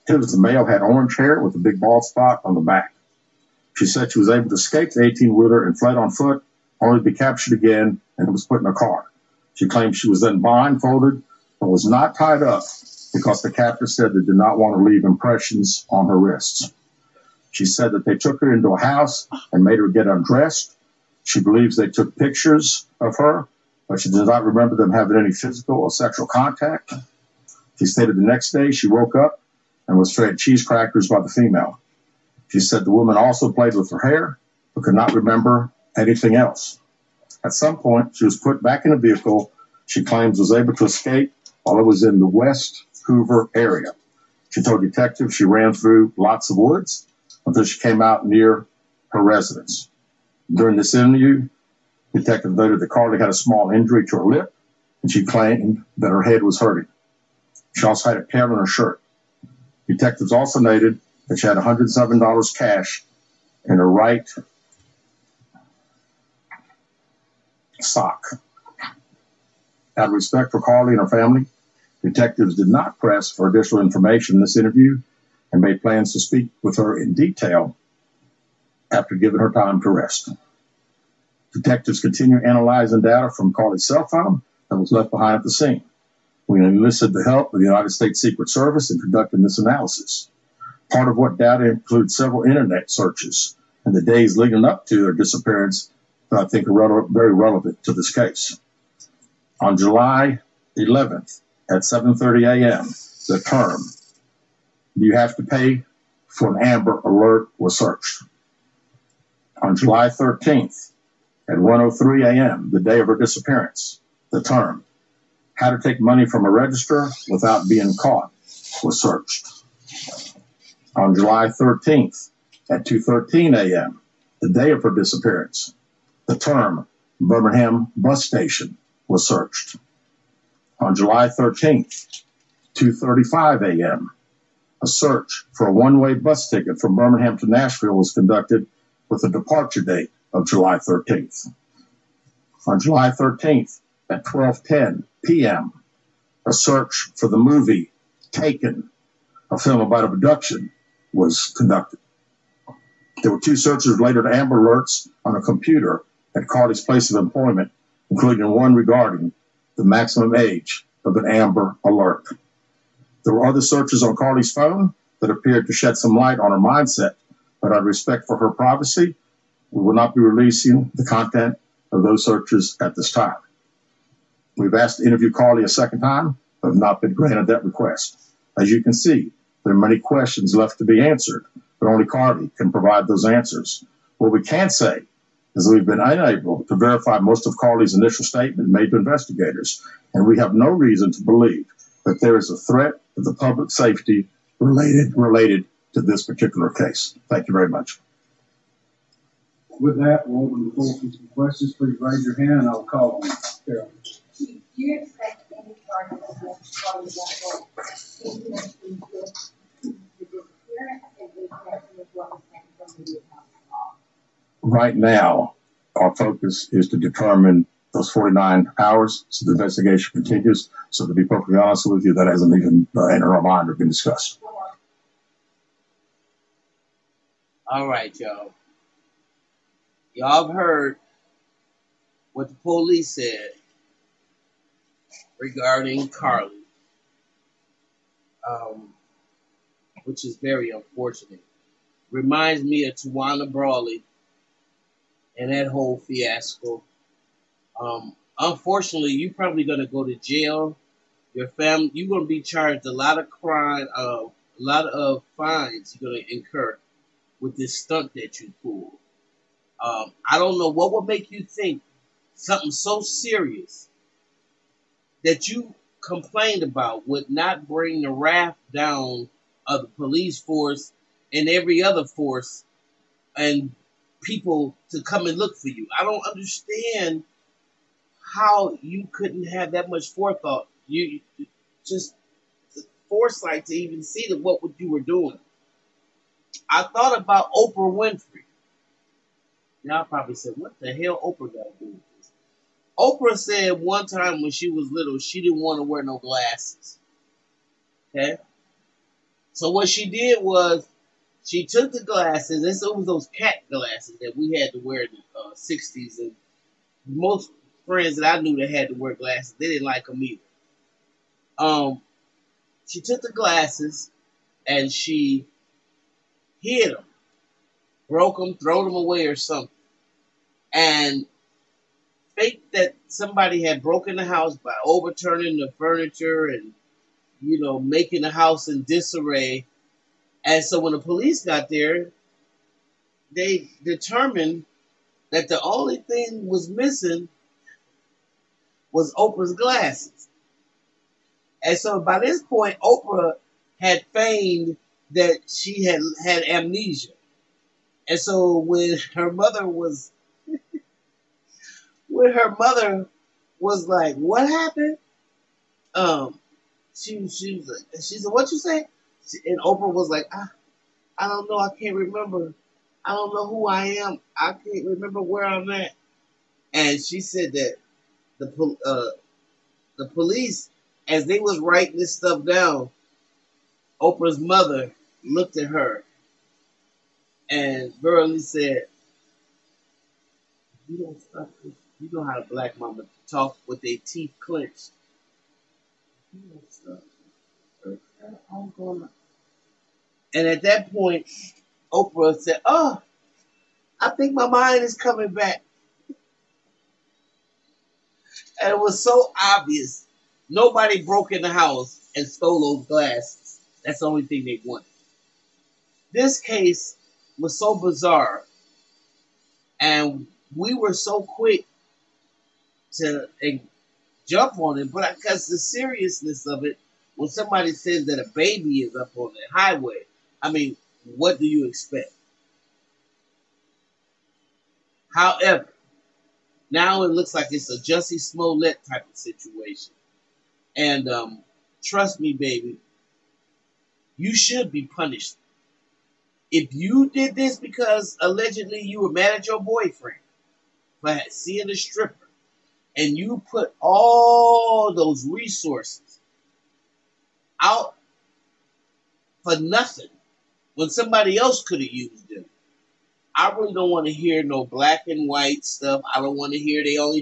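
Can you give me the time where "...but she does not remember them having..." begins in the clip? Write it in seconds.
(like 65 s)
23 s.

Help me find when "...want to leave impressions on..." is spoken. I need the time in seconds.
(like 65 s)
14 s.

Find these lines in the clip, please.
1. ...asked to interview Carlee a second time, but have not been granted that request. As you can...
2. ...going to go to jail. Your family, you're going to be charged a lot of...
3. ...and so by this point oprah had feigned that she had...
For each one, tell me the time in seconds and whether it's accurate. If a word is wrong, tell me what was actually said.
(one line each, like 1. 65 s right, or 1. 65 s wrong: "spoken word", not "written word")
1. 174 s right
2. 249 s right
3. 341 s right.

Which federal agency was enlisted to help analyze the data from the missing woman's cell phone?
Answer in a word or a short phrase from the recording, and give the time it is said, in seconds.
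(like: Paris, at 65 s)
United States Secret Service, at 87 s.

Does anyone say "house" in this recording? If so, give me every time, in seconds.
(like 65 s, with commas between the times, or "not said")
18 s, 324 s, 328 s, 401 s.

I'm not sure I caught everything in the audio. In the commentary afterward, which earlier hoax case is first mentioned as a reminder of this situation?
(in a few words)
Tawana Brawley.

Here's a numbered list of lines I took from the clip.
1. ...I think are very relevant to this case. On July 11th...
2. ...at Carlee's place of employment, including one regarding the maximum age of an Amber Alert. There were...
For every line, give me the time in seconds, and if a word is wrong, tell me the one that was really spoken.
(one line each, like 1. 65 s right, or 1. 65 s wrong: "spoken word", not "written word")
1. 96 s right
2. 156 s right.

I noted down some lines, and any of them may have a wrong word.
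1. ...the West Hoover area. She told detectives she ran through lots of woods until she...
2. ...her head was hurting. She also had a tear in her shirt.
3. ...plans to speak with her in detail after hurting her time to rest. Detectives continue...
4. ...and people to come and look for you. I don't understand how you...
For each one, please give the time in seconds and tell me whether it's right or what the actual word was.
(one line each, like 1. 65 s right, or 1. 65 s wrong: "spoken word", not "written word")
1. 42 s right
2. 56 s right
3. 75 s wrong: "giving", not "hurting"
4. 273 s right.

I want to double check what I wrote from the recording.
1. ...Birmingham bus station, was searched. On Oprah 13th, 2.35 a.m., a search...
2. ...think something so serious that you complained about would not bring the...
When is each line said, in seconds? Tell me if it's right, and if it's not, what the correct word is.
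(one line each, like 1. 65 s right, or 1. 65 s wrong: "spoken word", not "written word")
1. 127 s wrong: "July", not "Oprah"
2. 261 s right.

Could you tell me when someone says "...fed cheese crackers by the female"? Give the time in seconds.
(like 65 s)
30 s.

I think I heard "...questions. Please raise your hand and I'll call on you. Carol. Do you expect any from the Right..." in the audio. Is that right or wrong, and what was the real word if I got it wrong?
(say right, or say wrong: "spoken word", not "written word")
right.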